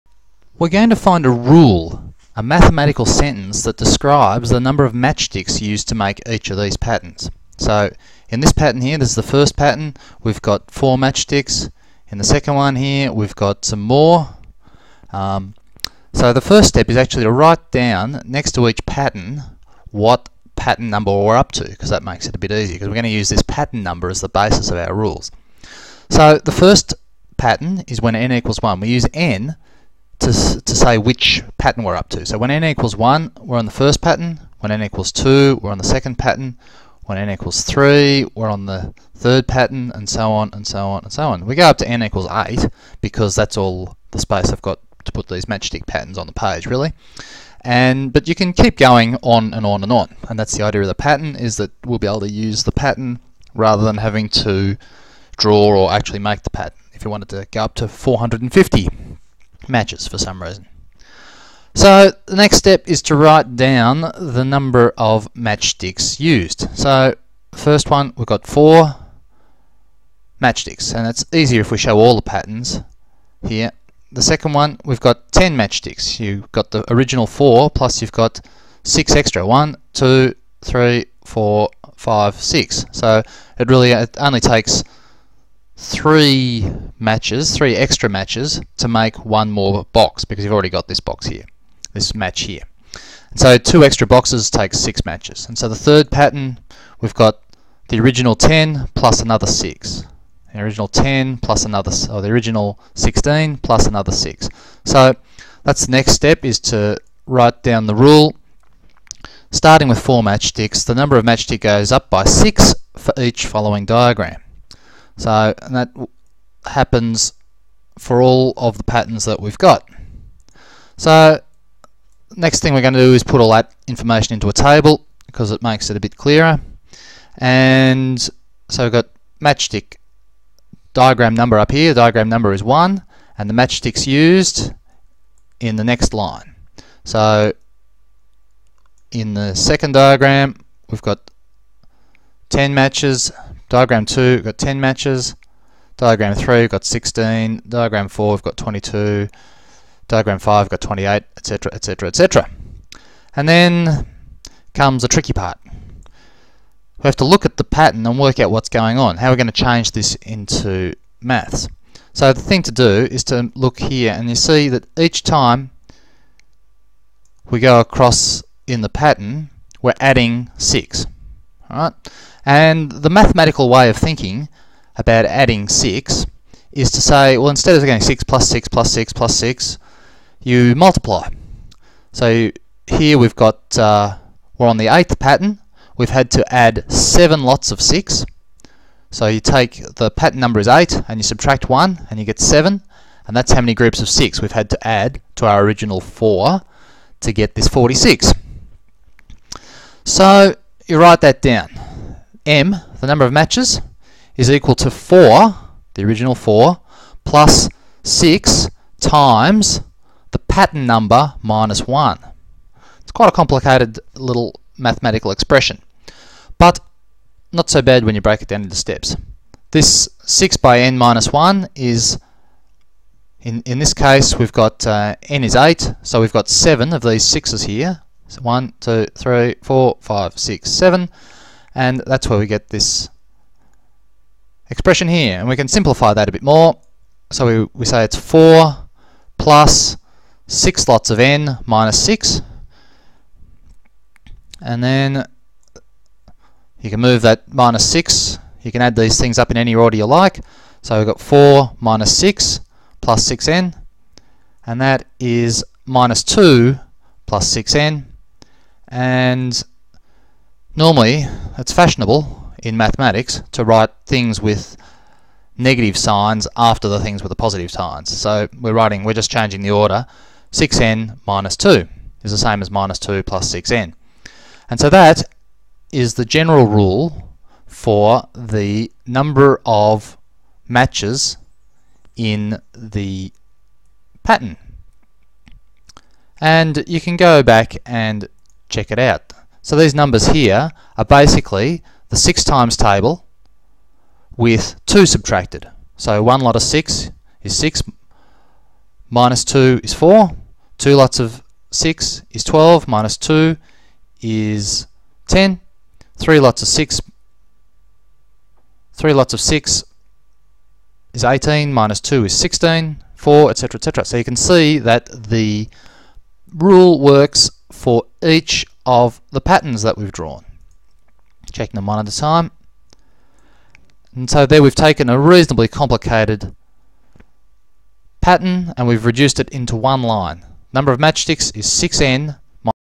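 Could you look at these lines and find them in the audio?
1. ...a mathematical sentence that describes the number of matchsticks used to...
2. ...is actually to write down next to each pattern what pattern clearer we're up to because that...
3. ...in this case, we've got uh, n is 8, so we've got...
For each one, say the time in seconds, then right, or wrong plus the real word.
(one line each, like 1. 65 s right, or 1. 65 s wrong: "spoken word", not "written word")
1. 2 s right
2. 16 s wrong: "number", not "clearer"
3. 223 s right.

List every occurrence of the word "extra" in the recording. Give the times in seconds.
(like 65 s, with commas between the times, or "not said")
79 s, 87 s, 93 s.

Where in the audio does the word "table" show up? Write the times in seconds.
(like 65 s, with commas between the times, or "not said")
124 s, 292 s.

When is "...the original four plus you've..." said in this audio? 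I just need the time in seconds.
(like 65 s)
76 s.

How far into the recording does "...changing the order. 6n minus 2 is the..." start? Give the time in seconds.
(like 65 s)
269 s.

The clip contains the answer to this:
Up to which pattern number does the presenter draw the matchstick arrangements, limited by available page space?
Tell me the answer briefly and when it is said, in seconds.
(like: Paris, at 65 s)
8, at 41 s.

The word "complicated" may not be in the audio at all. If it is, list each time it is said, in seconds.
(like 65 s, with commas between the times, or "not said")
213 s, 325 s.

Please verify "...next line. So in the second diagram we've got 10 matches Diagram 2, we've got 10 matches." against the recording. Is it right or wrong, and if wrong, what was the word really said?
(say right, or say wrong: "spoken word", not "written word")
right.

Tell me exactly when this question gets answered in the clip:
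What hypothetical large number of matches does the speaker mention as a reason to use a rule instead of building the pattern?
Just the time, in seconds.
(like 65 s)
57 s.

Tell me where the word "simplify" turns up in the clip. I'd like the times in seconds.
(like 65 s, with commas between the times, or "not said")
235 s.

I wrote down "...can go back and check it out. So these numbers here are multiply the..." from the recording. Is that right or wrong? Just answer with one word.
wrong.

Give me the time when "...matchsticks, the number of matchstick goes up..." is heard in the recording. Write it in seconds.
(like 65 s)
110 s.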